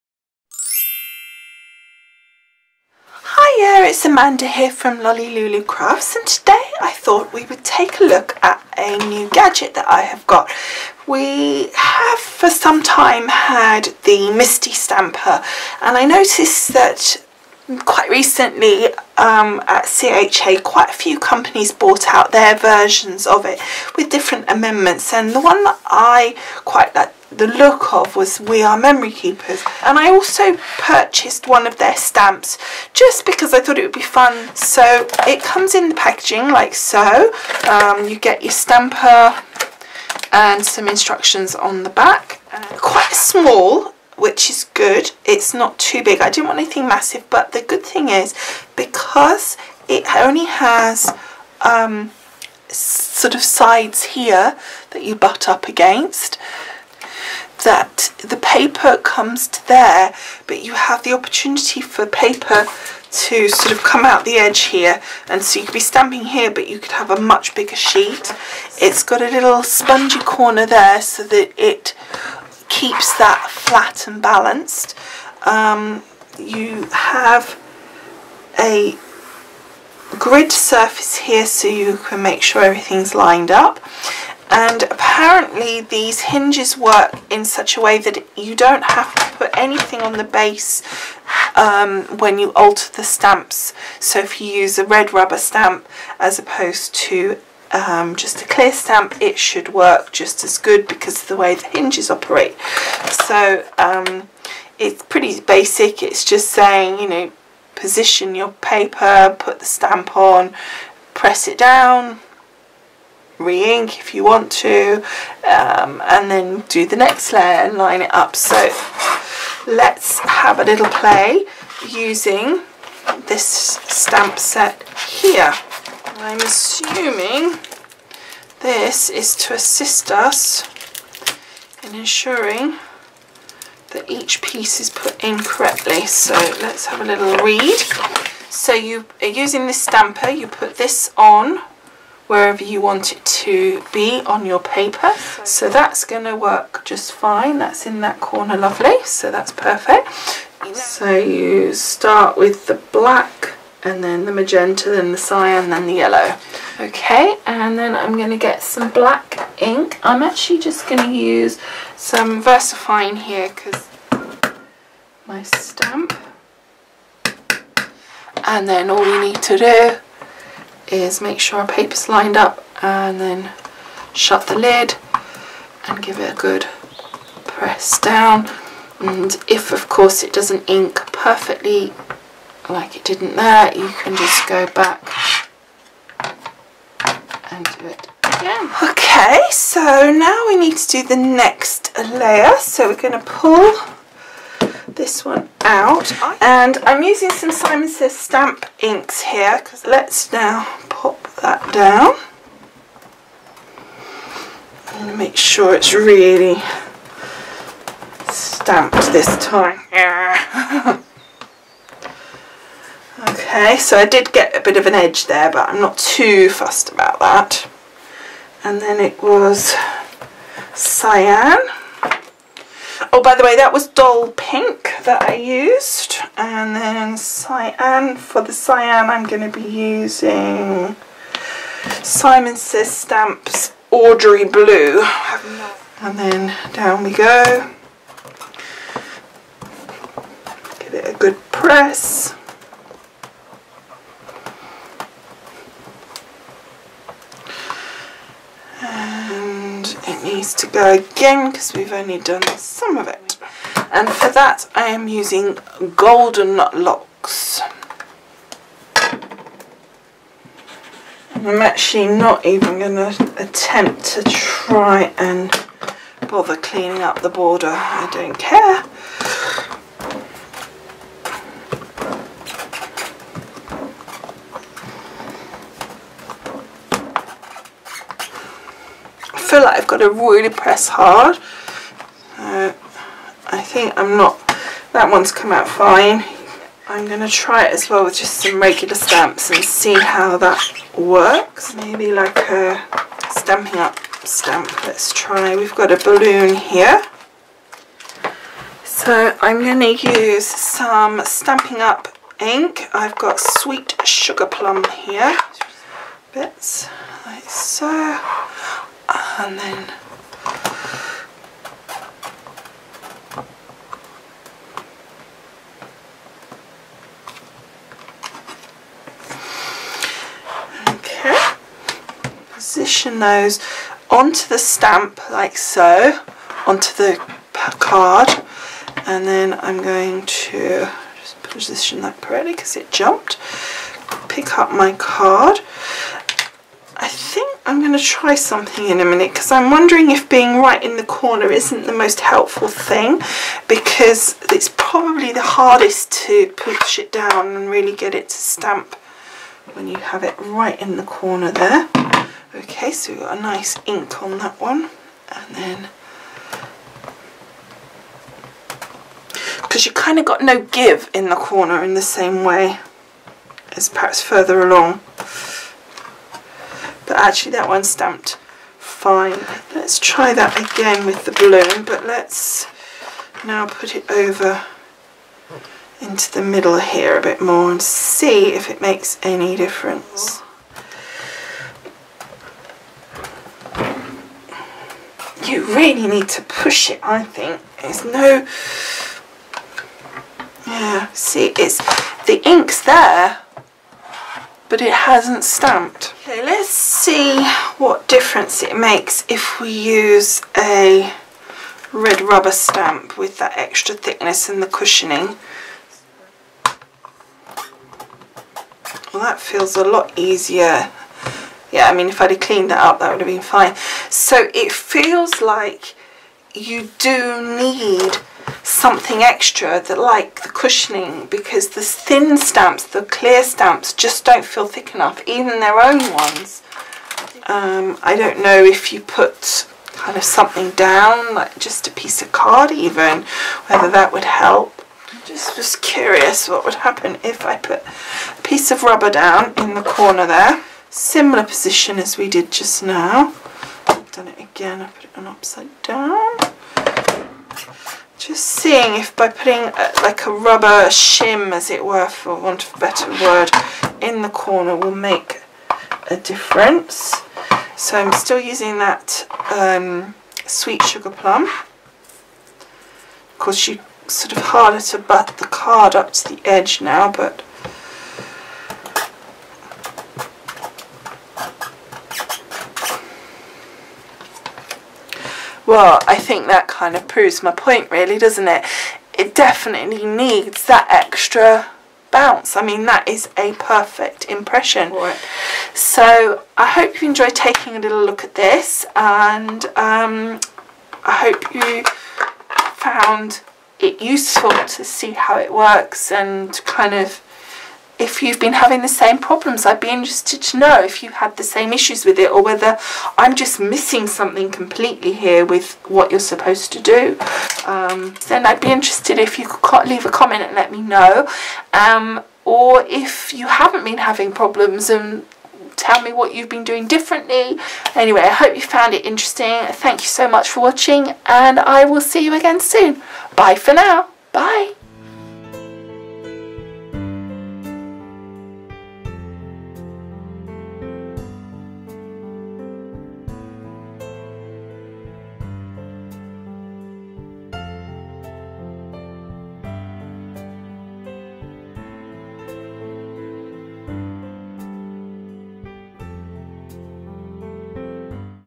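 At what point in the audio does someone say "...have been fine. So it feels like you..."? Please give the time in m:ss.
6:53.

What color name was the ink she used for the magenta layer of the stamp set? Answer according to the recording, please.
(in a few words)
dull pink.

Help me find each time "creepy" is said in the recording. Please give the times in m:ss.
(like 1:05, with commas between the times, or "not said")
not said.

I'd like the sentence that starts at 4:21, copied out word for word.
I'm actually not even going to attempt to try and bother cleaning up the border.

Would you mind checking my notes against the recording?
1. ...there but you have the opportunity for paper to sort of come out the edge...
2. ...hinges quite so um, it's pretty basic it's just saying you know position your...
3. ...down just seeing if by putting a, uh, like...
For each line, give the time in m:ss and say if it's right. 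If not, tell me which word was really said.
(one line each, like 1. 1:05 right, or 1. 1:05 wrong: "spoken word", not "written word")
1. 0:59 right
2. 1:41 wrong: "operate", not "quite"
3. 7:25 right.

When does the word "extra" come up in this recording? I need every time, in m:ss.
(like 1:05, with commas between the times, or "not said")
6:43, 6:59, 8:00.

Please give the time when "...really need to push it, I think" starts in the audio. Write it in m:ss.
6:25.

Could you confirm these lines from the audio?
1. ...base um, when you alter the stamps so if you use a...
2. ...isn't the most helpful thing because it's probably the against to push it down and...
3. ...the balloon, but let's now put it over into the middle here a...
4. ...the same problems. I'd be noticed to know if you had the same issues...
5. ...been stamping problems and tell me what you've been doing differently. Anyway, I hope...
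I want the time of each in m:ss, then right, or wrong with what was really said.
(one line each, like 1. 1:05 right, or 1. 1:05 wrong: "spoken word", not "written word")
1. 1:30 right
2. 5:41 wrong: "hardest", not "against"
3. 6:11 right
4. 8:18 wrong: "interested", not "noticed"
5. 8:33 wrong: "having", not "stamping".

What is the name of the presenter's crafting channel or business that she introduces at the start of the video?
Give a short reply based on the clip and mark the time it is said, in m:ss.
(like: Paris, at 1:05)
Lolli Lulu Crafts, at 0:05.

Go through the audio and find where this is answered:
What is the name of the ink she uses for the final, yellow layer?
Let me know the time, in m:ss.
4:15.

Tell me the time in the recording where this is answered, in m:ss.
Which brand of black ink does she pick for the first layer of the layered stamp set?
2:42.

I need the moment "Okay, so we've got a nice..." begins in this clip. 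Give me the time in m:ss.
5:52.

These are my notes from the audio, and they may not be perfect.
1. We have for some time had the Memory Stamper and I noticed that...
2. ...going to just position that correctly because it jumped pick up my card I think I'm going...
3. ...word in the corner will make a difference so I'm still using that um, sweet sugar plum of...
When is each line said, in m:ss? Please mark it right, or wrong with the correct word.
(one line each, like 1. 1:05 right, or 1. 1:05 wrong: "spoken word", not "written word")
1. 0:11 wrong: "MISTI", not "Memory"
2. 5:29 right
3. 7:33 right.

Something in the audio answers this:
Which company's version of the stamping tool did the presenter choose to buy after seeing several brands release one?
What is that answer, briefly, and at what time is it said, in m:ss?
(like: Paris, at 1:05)
We R Memory Keepers, at 0:28.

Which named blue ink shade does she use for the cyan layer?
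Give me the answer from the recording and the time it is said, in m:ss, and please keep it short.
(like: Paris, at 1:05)
Audrey Blue, at 3:53.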